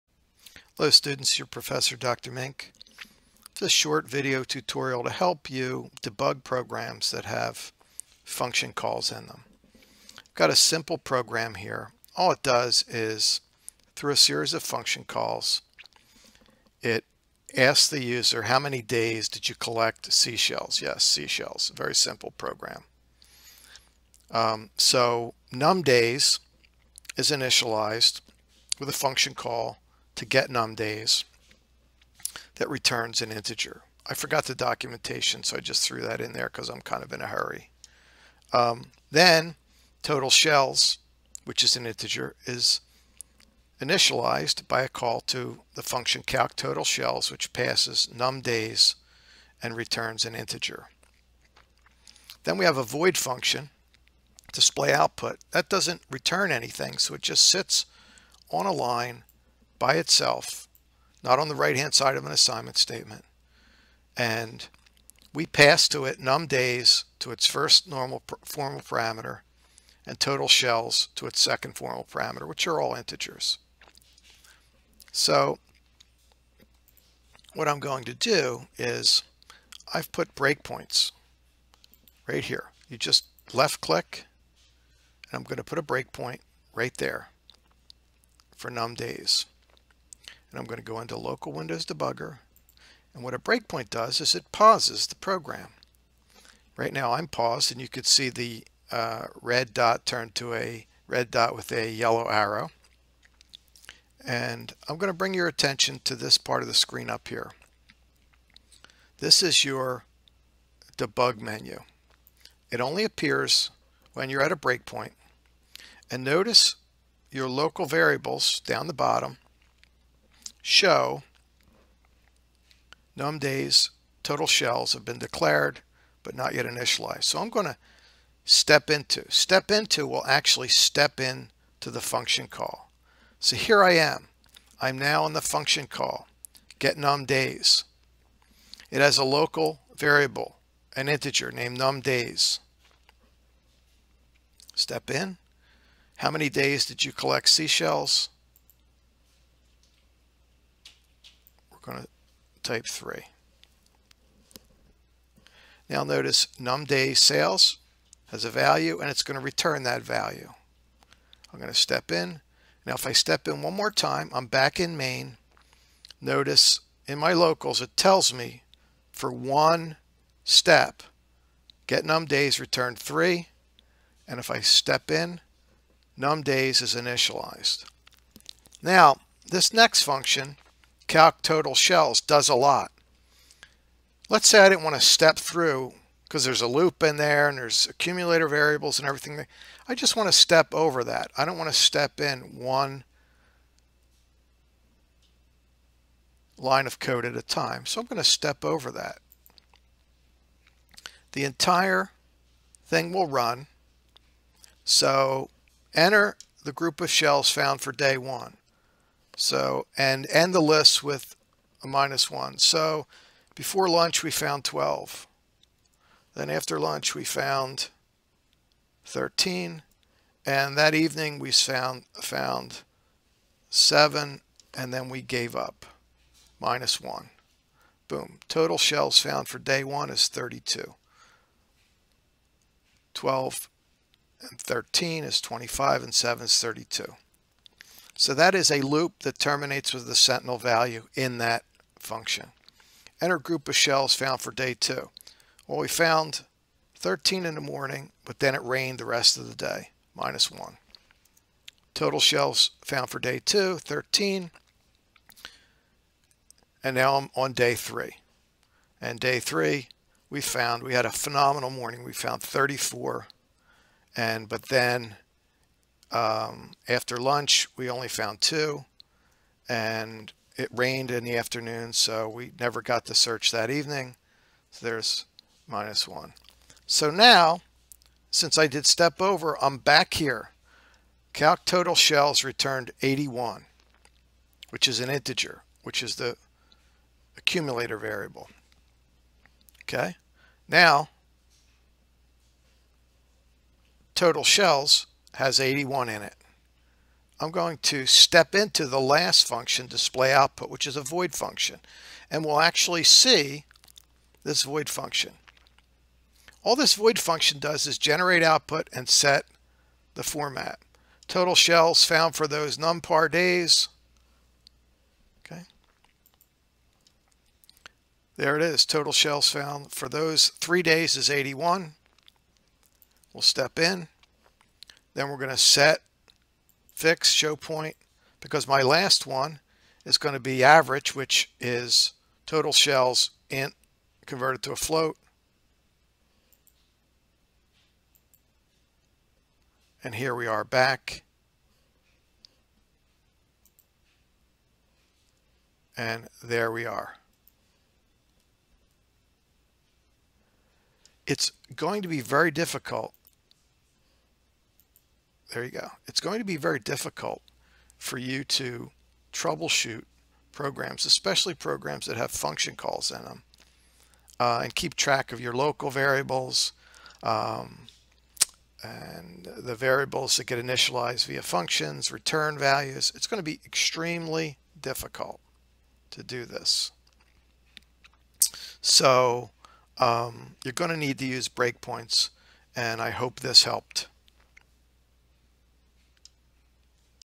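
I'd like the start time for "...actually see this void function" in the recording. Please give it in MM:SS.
05:02.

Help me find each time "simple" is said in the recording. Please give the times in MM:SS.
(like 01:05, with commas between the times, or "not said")
00:10, 00:21.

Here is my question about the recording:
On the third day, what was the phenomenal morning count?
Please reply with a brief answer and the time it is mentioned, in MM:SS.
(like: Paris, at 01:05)
34, at 04:22.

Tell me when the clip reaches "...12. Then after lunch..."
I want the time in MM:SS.
03:34.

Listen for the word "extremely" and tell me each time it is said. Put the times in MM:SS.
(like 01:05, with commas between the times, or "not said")
06:13.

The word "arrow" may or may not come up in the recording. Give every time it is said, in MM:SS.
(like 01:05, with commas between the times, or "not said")
01:42.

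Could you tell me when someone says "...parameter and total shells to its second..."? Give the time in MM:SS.
01:08.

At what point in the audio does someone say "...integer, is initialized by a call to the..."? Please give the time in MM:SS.
00:41.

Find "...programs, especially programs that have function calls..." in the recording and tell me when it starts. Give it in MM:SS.
06:00.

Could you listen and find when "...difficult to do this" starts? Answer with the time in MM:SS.
06:14.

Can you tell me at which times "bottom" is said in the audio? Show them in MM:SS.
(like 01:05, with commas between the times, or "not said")
01:58.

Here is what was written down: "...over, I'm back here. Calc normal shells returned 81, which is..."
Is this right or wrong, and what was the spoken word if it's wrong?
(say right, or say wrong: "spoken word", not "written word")
wrong: "total", not "normal".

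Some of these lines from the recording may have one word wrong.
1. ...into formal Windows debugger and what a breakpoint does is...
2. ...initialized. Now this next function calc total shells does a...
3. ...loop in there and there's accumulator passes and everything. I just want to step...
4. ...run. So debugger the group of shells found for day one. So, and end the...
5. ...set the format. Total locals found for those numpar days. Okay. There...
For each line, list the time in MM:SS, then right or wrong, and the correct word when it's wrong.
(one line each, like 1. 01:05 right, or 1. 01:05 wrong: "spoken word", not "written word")
1. 01:30 wrong: "local", not "formal"
2. 02:56 right
3. 03:06 wrong: "variables", not "passes"
4. 03:23 wrong: "enter", not "debugger"
5. 05:09 wrong: "shells", not "locals".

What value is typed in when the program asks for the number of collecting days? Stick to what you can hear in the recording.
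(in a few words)
3.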